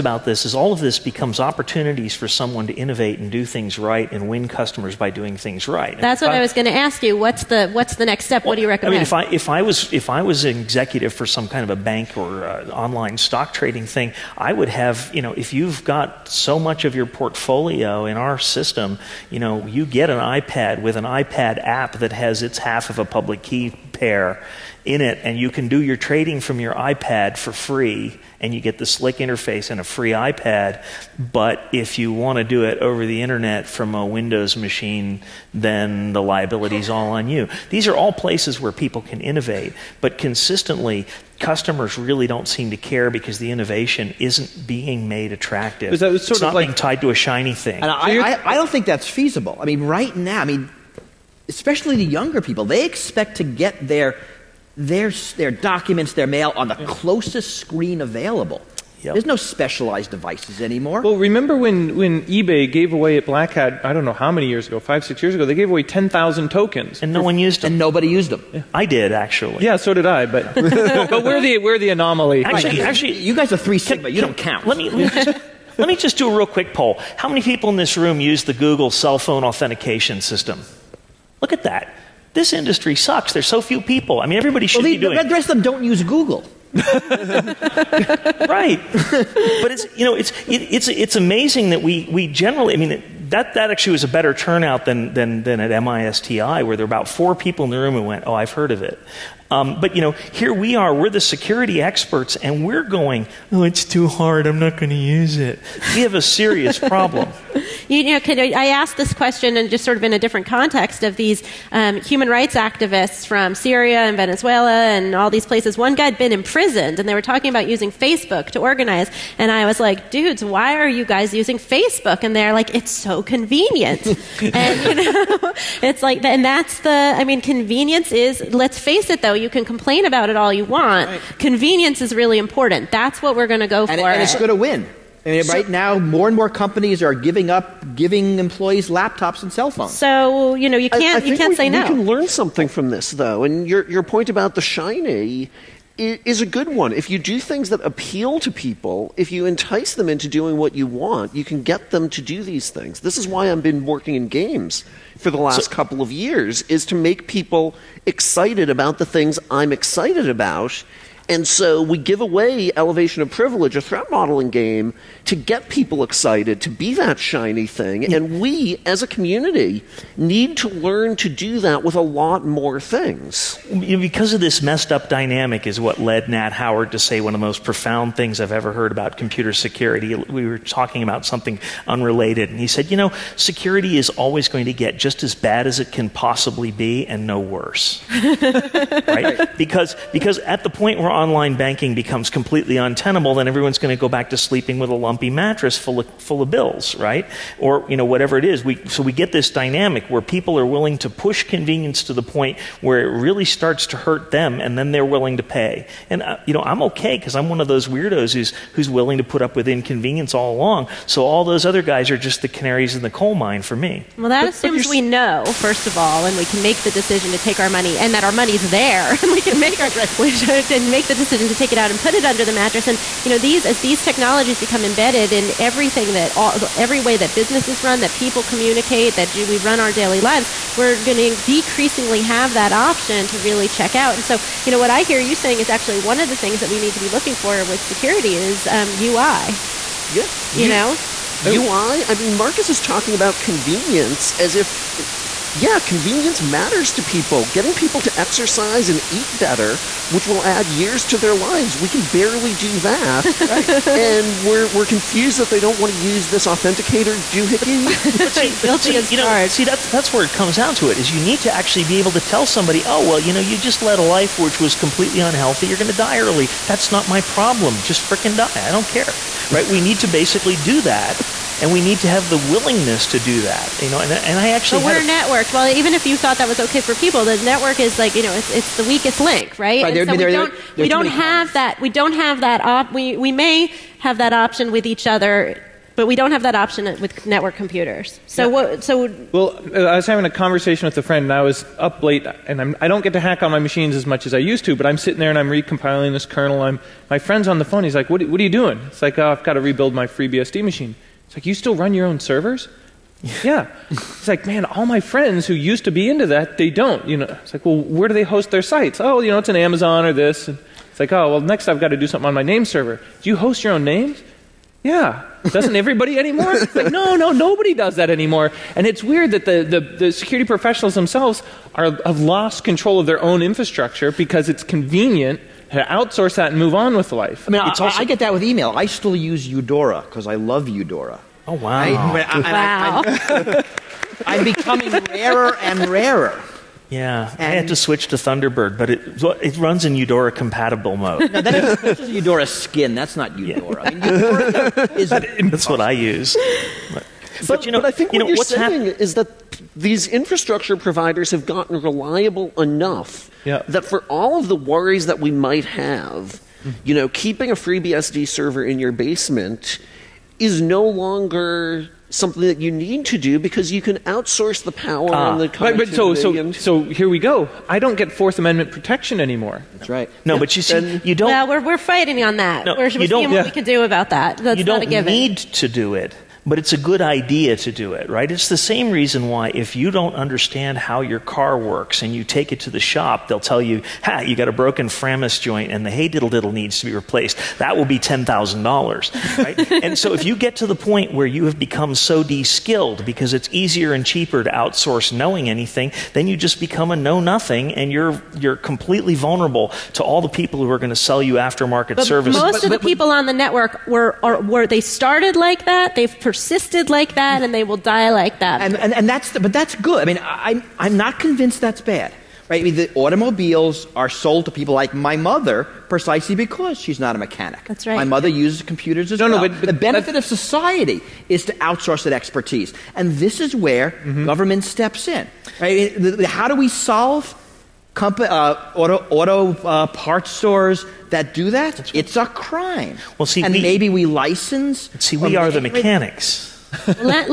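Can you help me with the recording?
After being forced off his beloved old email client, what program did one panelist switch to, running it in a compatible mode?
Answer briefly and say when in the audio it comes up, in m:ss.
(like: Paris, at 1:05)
Thunderbird, at 5:38.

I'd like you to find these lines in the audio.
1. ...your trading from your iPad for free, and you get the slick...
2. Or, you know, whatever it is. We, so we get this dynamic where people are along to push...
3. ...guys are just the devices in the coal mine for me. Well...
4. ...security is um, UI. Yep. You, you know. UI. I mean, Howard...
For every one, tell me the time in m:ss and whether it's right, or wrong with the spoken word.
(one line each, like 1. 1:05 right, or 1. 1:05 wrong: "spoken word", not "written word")
1. 0:25 right
2. 3:17 wrong: "willing", not "along"
3. 3:31 wrong: "canaries", not "devices"
4. 3:57 wrong: "Marcus", not "Howard".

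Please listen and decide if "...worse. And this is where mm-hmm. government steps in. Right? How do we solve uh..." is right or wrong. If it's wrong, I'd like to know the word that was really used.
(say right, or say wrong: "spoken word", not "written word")
wrong: "expertise", not "worse".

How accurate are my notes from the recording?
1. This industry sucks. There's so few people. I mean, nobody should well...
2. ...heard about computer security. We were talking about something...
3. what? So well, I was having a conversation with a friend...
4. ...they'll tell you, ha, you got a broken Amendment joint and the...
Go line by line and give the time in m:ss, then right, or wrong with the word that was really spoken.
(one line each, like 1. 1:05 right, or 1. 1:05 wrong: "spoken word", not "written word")
1. 1:22 wrong: "everybody", not "nobody"
2. 2:58 right
3. 4:48 right
4. 6:23 wrong: "Framus", not "Amendment".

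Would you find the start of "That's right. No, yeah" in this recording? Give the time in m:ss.
6:09.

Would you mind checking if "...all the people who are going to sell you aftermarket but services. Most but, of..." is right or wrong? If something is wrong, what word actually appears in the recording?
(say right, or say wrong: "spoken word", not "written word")
right.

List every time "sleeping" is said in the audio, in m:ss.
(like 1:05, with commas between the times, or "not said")
3:14.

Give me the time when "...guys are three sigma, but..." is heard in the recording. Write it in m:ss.
1:13.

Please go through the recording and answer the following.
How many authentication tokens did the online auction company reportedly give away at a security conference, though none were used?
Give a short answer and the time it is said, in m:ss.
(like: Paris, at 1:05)
10,000, at 1:05.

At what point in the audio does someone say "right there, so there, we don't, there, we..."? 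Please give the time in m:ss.
4:39.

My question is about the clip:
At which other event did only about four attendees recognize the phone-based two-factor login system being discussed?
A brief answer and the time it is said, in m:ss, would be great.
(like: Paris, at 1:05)
MISTI, at 1:35.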